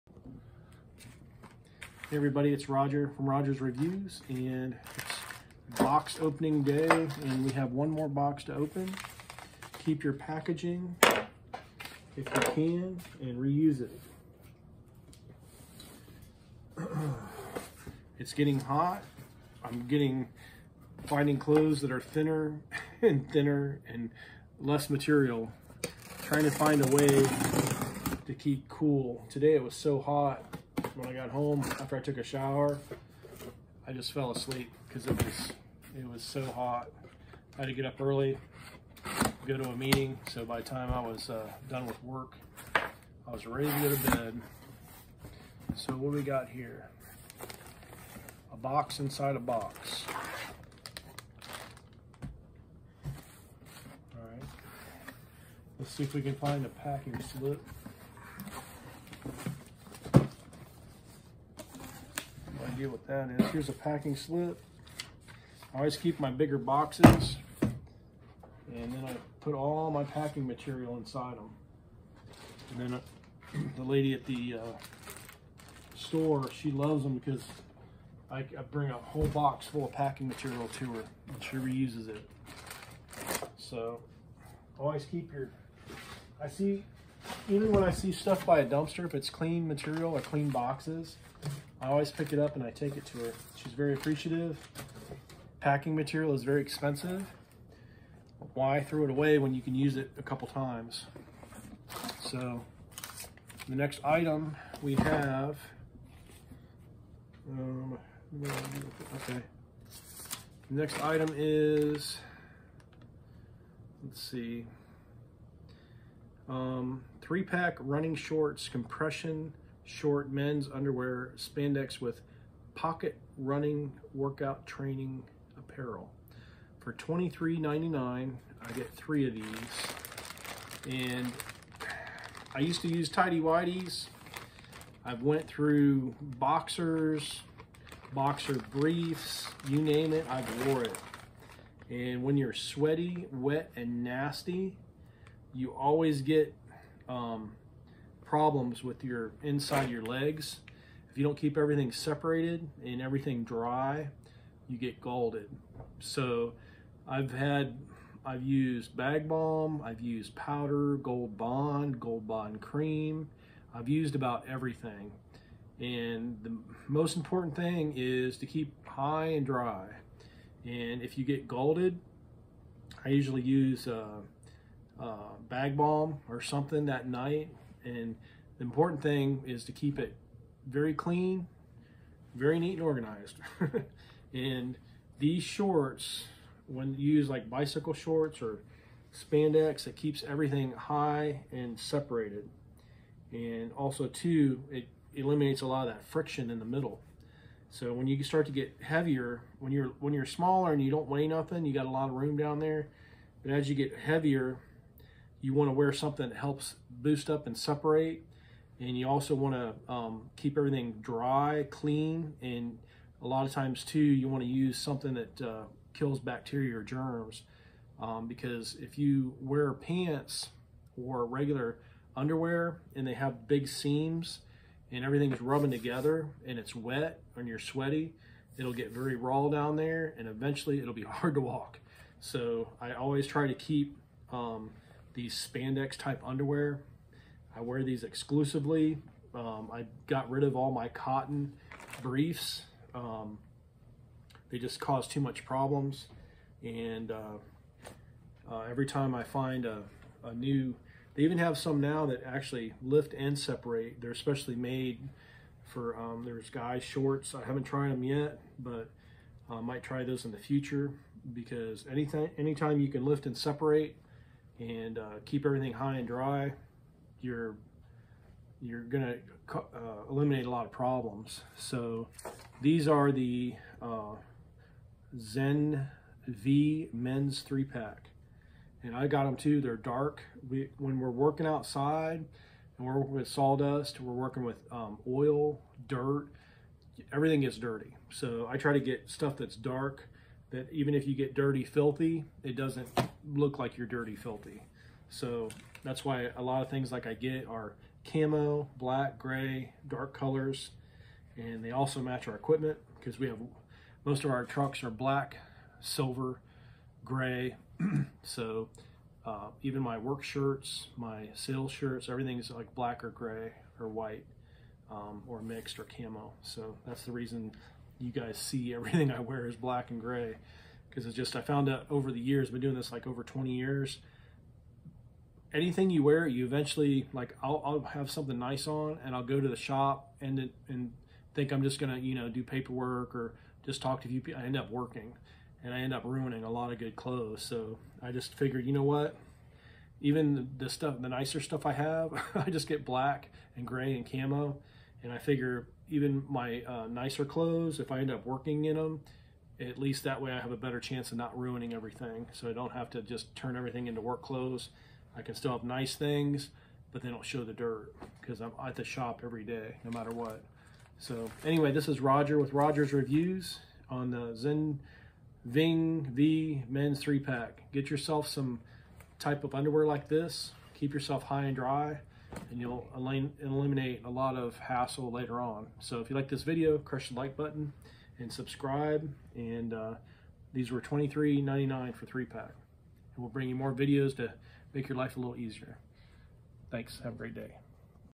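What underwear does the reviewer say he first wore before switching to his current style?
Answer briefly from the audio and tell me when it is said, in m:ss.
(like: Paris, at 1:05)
tidy whiteys, at 2:13.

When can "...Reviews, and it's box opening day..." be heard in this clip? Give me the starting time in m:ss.
0:03.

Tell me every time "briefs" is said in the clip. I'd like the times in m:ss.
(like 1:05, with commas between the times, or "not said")
2:18, 4:02.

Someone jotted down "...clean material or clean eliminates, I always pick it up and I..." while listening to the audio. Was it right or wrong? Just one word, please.
wrong.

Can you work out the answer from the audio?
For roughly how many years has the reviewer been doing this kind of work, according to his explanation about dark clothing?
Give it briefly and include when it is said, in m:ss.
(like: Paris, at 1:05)
over 20 years, at 5:23.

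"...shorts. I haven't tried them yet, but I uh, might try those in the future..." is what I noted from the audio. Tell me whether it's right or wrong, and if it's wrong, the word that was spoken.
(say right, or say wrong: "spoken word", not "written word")
right.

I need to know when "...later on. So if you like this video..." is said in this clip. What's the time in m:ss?
6:15.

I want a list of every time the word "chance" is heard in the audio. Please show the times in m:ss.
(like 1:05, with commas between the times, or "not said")
5:50.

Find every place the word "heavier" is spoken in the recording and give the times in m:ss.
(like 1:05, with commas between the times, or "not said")
3:18, 3:23.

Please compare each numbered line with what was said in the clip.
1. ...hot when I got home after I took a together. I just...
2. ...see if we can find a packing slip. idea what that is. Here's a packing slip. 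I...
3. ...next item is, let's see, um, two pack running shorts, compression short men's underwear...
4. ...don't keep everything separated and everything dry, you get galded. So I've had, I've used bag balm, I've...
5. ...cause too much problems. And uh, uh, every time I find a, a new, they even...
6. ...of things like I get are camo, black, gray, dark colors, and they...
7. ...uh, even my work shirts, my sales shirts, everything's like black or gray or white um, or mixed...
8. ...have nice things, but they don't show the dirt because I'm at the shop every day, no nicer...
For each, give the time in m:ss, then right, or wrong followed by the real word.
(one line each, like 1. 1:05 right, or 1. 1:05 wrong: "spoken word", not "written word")
1. 0:30 wrong: "shower", not "together"
2. 0:55 right
3. 1:50 wrong: "three", not "two"
4. 2:31 right
5. 4:04 right
6. 4:56 right
7. 5:09 right
8. 5:55 wrong: "matter", not "nicer".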